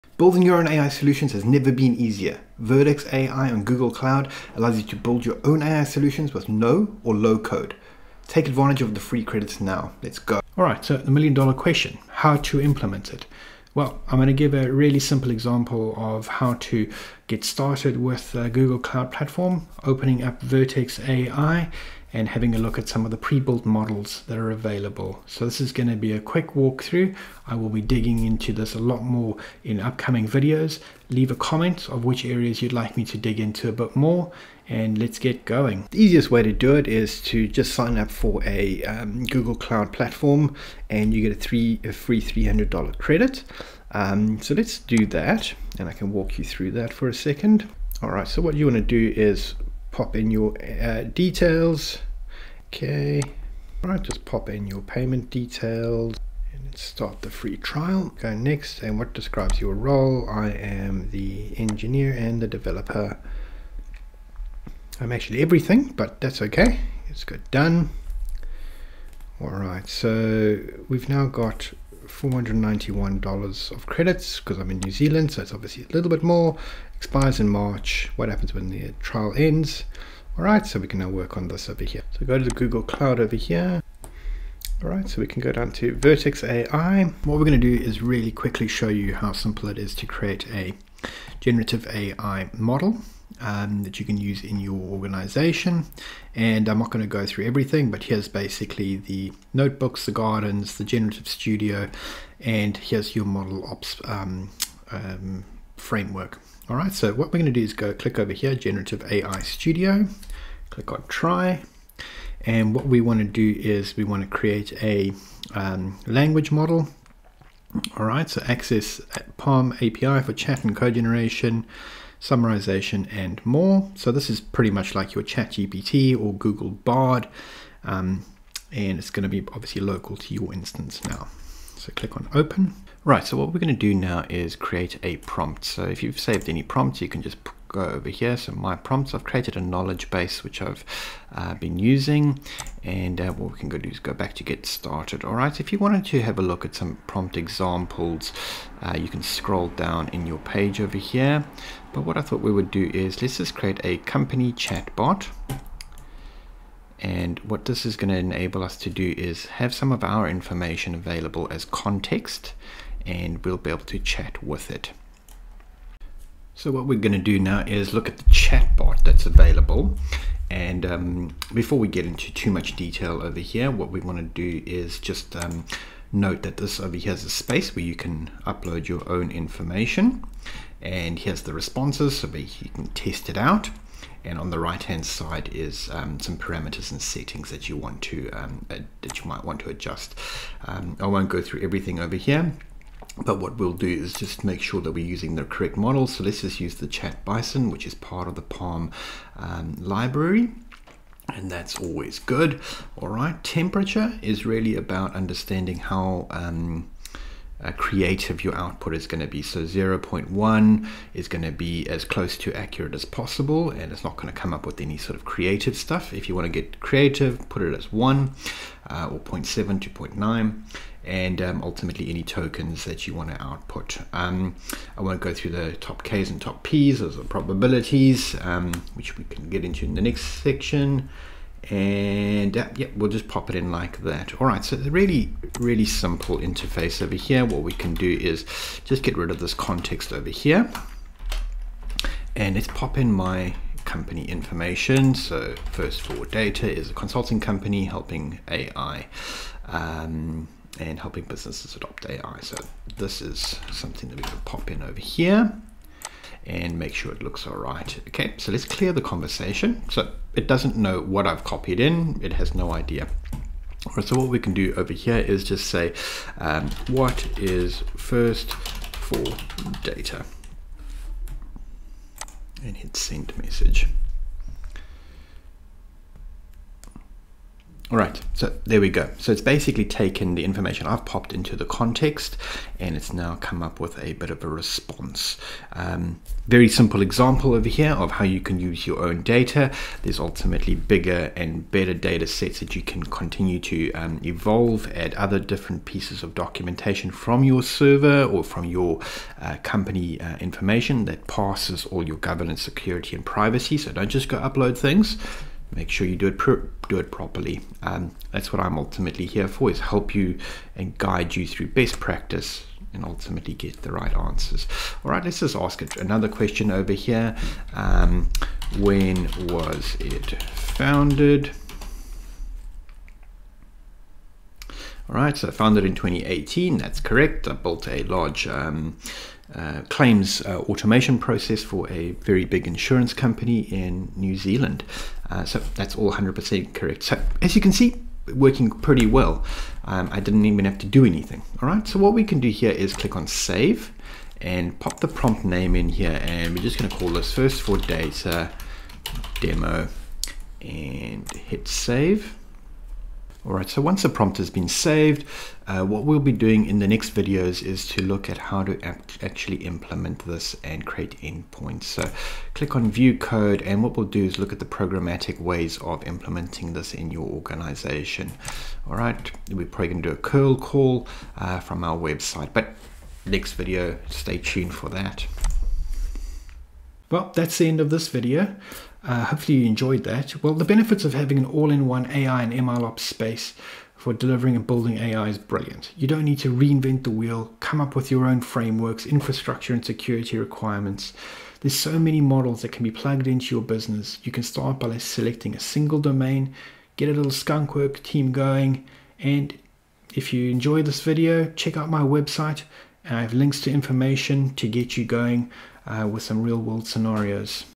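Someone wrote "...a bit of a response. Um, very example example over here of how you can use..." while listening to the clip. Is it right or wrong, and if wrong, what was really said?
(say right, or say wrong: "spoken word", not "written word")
wrong: "simple", not "example".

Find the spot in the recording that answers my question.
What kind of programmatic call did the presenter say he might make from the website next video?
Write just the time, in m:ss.
6:10.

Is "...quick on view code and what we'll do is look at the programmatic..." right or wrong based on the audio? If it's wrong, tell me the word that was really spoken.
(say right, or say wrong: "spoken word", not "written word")
wrong: "click", not "quick".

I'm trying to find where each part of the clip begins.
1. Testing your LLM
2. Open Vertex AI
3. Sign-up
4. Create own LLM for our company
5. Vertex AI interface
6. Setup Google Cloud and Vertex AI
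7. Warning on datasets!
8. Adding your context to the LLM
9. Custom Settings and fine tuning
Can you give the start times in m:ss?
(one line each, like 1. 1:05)
1. 5:23
2. 1:24
3. 0:39
4. 1:55
5. 1:38
6. 0:11
7. 4:54
8. 4:23
9. 3:10.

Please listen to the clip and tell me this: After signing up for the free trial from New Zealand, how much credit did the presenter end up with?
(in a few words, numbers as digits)
$491.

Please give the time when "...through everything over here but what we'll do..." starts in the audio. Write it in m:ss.
3:11.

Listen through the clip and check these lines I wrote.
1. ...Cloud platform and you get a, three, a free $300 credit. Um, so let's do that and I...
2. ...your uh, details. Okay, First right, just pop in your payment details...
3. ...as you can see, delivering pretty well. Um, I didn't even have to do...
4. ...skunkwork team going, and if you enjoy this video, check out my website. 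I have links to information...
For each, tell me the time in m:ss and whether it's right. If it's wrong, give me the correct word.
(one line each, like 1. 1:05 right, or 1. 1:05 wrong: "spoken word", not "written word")
1. 0:39 right
2. 0:50 wrong: "All", not "First"
3. 5:37 wrong: "working", not "delivering"
4. 6:37 right.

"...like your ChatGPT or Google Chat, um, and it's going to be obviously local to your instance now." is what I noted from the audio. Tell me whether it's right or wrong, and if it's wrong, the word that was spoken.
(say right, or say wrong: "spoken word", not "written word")
wrong: "Bard", not "Chat".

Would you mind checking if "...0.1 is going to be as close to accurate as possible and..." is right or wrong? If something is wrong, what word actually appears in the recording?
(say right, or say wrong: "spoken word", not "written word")
right.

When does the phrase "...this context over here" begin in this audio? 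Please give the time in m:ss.
3:59.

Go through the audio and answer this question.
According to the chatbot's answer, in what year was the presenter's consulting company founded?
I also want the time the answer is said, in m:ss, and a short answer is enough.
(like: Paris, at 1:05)
2018, at 5:25.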